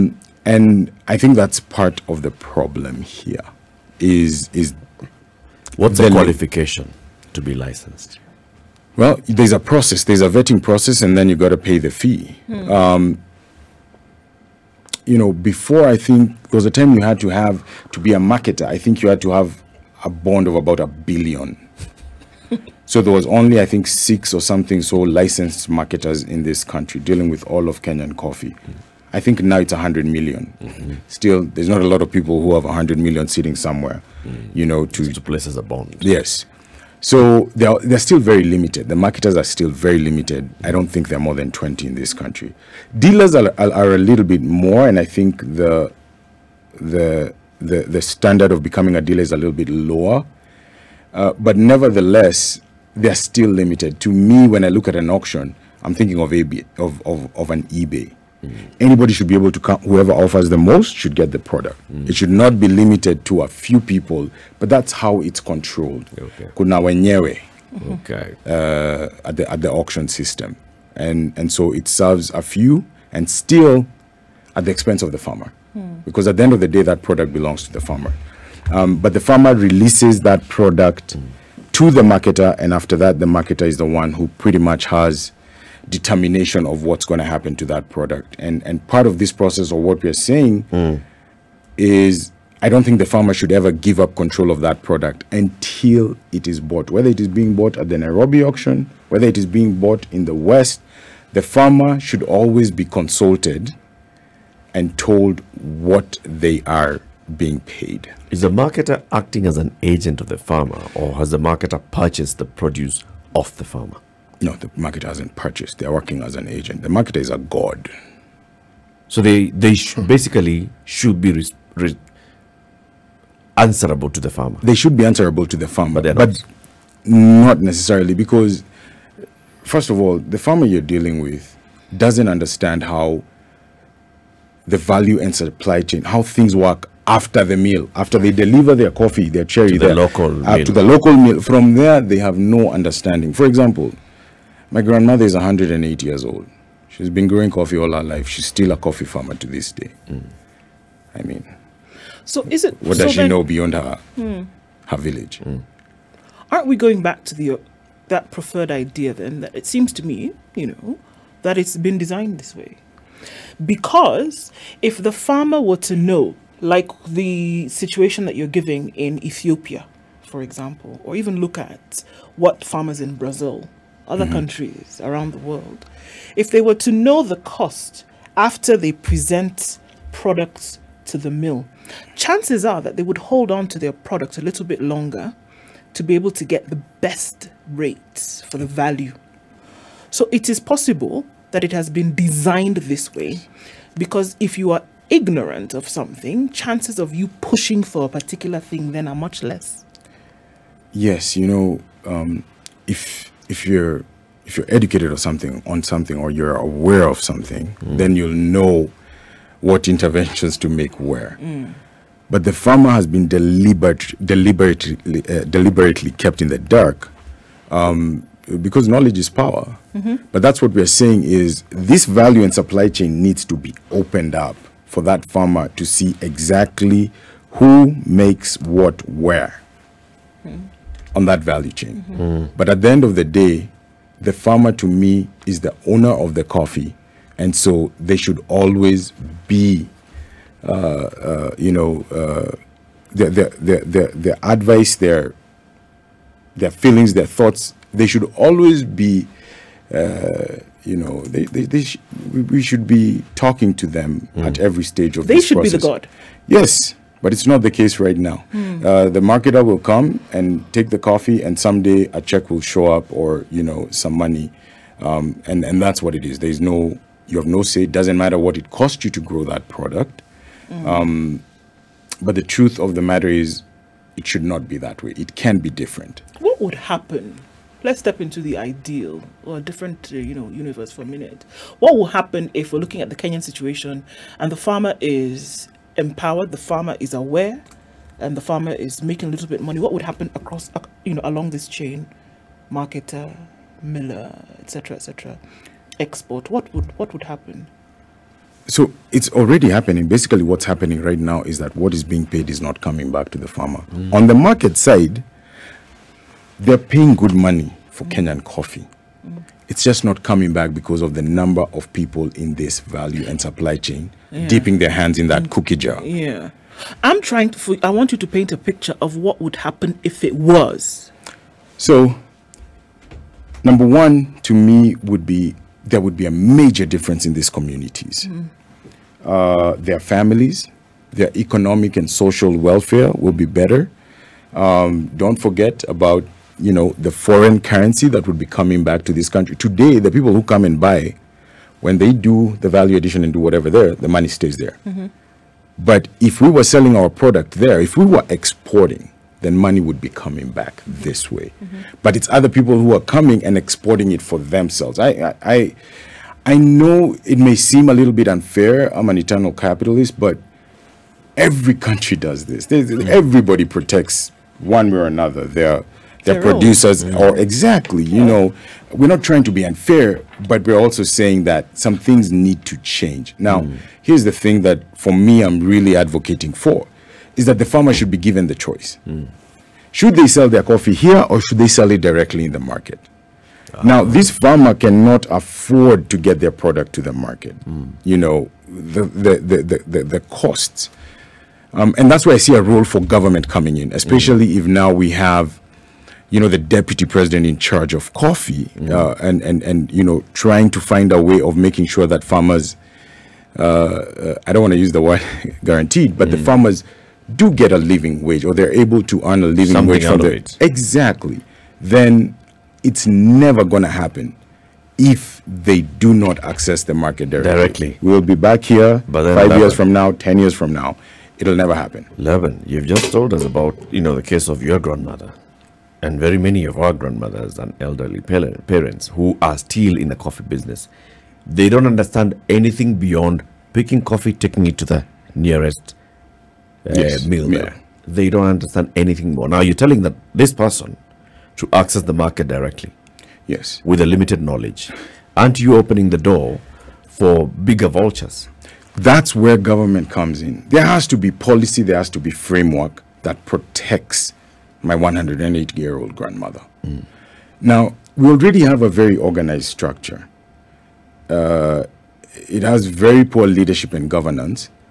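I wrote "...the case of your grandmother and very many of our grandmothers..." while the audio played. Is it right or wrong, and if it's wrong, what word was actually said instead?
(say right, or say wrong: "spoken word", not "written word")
right.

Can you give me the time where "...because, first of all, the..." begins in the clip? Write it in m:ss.
2:08.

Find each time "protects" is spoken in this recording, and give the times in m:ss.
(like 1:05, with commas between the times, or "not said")
6:03, 7:33.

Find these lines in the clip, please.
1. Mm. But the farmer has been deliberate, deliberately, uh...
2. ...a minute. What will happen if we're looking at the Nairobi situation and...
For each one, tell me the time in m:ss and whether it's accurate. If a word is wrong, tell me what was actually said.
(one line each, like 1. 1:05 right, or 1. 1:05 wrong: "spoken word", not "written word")
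1. 3:31 right
2. 4:41 wrong: "Kenyan", not "Nairobi".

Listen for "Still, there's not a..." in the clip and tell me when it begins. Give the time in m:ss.
0:31.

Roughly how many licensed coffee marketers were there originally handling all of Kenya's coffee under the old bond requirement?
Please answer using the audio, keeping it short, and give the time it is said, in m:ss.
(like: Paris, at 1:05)
6, at 0:23.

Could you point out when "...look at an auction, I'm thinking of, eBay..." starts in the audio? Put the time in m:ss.
0:54.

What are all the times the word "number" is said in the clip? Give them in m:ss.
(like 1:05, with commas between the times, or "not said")
5:11, 5:23.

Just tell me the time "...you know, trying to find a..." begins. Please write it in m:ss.
6:39.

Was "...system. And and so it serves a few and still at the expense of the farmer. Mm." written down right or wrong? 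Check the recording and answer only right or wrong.
right.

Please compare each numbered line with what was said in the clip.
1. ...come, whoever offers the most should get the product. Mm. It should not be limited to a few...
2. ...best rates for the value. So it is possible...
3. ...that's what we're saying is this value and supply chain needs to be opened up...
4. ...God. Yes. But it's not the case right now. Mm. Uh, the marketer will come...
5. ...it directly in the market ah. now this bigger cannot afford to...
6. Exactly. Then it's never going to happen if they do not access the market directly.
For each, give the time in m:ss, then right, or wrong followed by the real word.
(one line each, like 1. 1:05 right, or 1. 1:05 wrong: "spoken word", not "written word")
1. 0:59 right
2. 3:06 right
3. 3:40 right
4. 4:15 right
5. 6:21 wrong: "farmer", not "bigger"
6. 6:50 right.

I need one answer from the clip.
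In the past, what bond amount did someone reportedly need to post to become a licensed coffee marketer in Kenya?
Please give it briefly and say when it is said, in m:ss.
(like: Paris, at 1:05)
1 billion, at 0:20.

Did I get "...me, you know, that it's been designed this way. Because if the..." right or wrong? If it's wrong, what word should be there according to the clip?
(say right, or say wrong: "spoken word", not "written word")
right.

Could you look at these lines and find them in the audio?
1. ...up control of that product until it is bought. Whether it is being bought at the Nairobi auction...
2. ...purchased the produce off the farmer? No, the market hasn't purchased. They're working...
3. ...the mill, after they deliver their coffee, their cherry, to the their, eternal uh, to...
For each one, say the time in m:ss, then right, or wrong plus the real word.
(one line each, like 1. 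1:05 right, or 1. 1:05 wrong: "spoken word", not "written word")
1. 1:33 right
2. 1:51 right
3. 2:17 wrong: "local", not "eternal".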